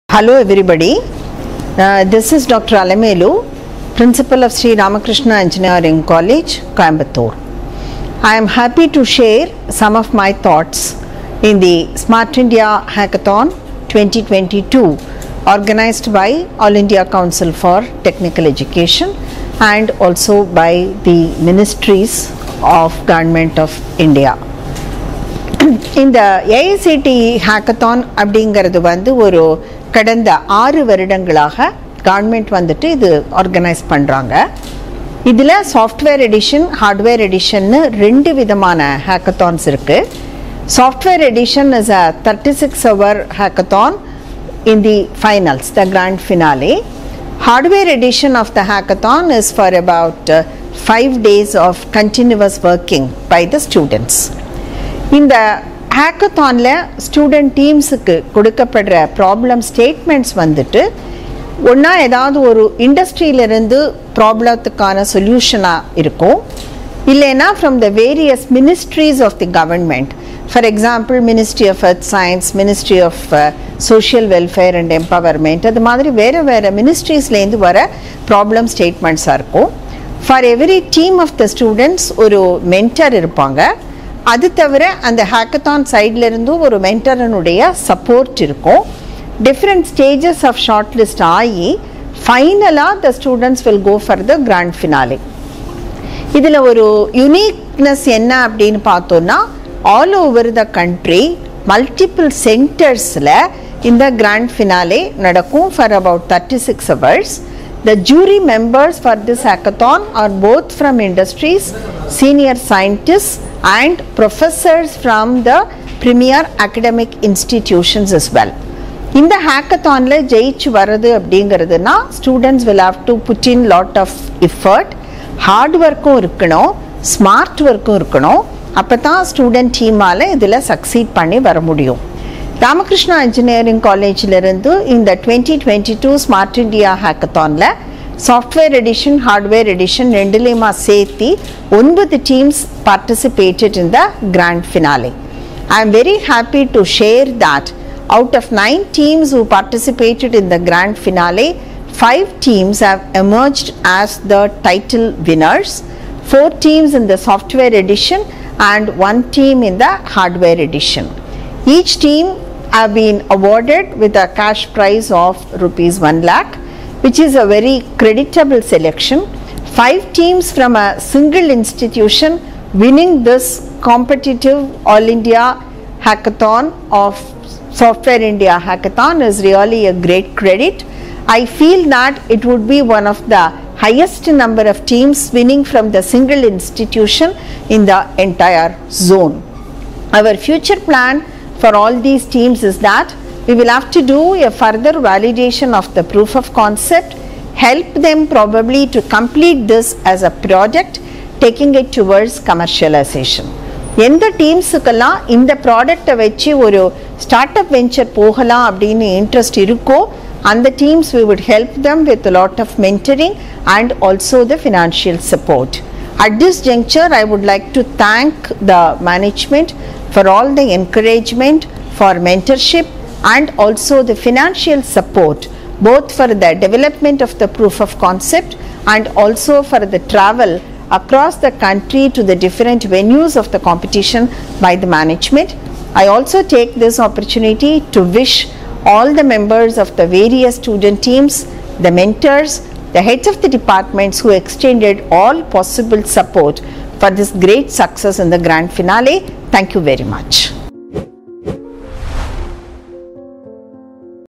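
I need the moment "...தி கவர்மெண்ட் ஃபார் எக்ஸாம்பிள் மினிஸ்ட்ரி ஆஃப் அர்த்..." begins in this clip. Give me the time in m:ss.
1:09.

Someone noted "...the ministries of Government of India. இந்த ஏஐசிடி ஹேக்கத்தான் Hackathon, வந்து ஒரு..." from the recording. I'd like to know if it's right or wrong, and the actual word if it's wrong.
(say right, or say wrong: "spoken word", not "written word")
right.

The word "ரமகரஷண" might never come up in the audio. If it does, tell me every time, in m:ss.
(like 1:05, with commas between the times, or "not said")
2:12.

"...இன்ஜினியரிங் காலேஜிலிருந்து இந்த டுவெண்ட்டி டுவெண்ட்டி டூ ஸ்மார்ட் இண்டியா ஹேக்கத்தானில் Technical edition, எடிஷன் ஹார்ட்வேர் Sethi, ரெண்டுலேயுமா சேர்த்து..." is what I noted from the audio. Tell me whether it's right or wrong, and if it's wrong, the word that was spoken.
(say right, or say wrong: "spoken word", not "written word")
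wrong: "Software", not "Technical".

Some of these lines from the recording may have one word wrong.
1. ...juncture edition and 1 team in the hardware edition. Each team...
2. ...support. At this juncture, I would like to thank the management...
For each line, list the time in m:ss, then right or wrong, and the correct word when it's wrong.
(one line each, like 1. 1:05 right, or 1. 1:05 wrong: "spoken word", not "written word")
1. 2:37 wrong: "software", not "juncture"
2. 3:35 right.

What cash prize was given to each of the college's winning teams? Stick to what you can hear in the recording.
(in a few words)
1 lakh rupees.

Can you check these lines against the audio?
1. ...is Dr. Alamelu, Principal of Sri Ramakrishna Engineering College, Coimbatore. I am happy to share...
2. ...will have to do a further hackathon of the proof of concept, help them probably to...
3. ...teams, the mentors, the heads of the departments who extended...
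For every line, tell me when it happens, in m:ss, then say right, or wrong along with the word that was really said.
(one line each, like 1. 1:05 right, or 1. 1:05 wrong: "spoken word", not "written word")
1. 0:02 right
2. 3:13 wrong: "validation", not "hackathon"
3. 4:01 right.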